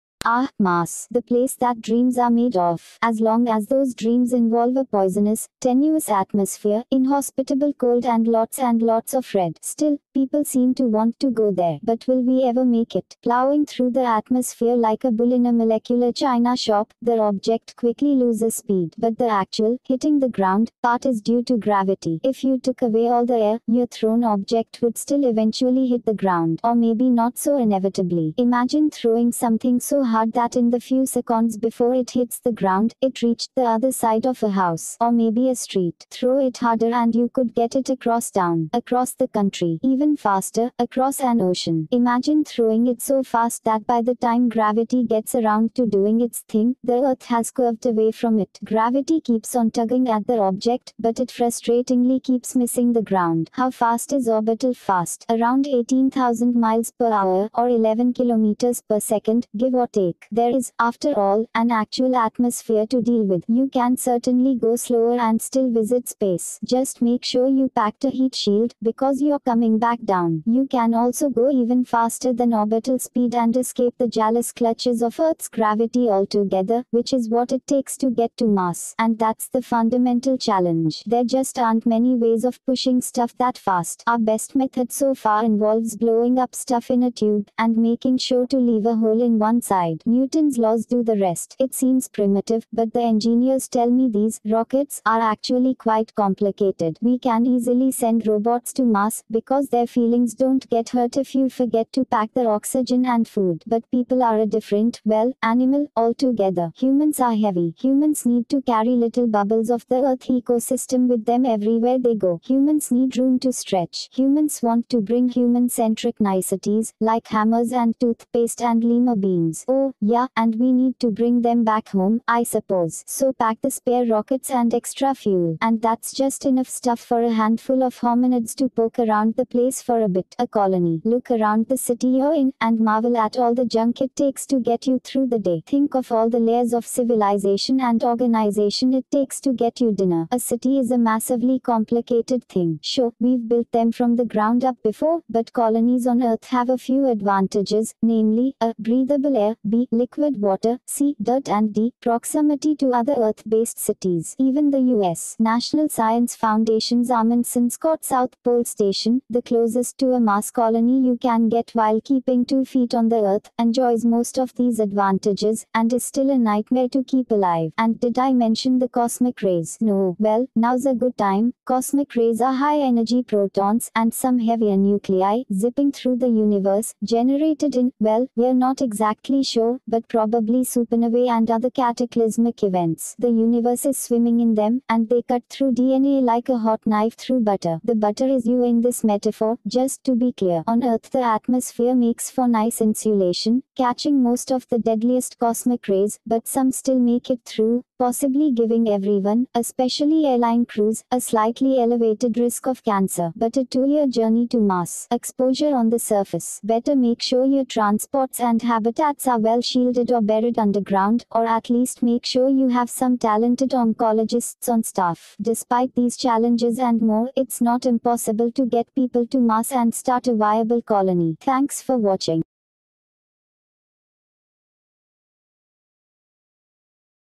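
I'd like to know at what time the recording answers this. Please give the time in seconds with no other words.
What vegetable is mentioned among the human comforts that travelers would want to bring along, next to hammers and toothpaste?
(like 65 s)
118 s.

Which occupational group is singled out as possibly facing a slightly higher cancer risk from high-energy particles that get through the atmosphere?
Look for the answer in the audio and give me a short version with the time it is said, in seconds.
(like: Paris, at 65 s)
Airline crews, at 200 s.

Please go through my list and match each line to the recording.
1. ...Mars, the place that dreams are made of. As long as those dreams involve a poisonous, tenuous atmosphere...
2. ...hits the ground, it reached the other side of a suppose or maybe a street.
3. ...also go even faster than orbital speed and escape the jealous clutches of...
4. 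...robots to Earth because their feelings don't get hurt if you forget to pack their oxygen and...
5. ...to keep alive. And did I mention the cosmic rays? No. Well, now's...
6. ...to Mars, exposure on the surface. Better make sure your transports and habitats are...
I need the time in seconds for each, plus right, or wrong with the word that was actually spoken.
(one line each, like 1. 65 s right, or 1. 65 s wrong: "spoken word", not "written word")
1. 0 s right
2. 32 s wrong: "house", not "suppose"
3. 70 s right
4. 98 s wrong: "Mars", not "Earth"
5. 166 s right
6. 204 s right.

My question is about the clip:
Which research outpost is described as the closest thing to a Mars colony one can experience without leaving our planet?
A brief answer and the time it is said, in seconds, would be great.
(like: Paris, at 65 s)
Amundsen Scott South Pole Station, at 157 s.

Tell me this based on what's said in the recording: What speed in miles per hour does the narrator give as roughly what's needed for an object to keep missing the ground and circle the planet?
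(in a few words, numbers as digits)
18,000 miles per hour.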